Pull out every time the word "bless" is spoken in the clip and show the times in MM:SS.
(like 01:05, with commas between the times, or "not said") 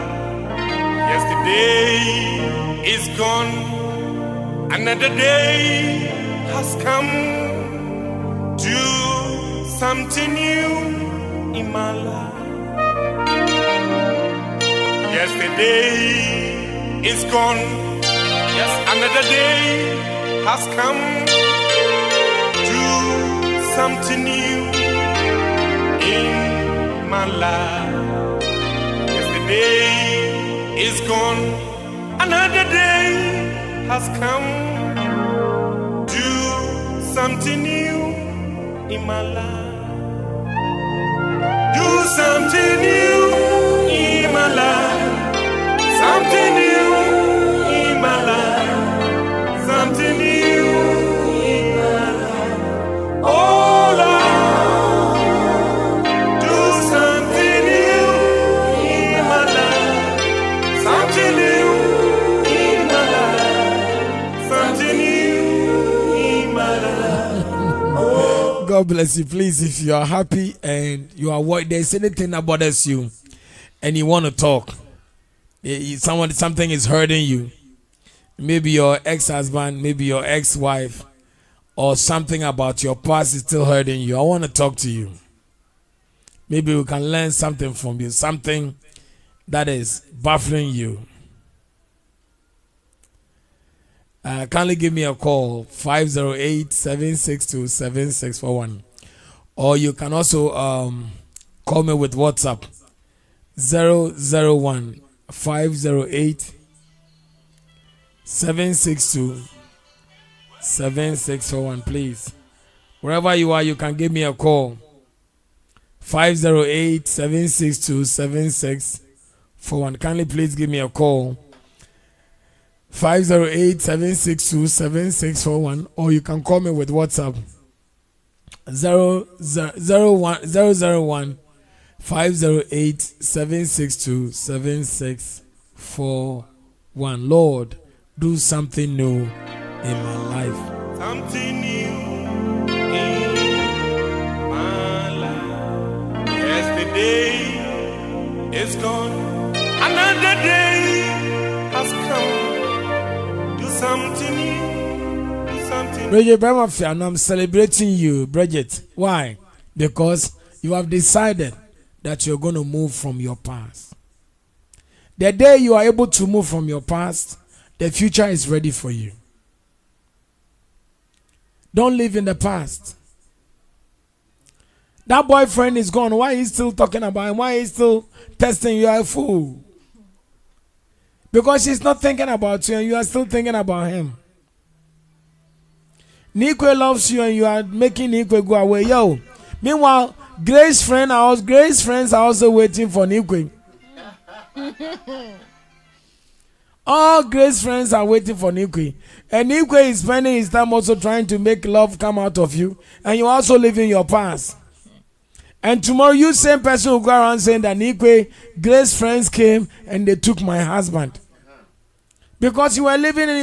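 01:08.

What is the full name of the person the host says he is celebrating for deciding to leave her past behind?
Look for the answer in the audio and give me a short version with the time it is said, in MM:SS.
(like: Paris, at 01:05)
Bridget Bremafia, at 02:36.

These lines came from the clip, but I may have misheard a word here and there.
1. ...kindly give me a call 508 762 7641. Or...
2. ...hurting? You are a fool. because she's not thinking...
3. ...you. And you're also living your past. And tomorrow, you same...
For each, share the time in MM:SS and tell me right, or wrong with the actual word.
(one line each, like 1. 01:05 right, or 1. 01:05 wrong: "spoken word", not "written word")
1. 01:34 right
2. 02:58 wrong: "testing", not "hurting"
3. 03:22 right.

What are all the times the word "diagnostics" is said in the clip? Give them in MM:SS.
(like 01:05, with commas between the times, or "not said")
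not said.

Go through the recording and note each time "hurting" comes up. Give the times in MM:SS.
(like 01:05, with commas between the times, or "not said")
01:16, 01:23.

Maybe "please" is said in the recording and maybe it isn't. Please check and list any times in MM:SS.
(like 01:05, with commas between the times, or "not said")
01:09, 01:51, 02:00.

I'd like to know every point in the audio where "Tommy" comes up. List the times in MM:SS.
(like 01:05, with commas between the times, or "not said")
not said.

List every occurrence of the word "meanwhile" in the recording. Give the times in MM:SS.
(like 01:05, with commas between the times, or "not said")
03:09.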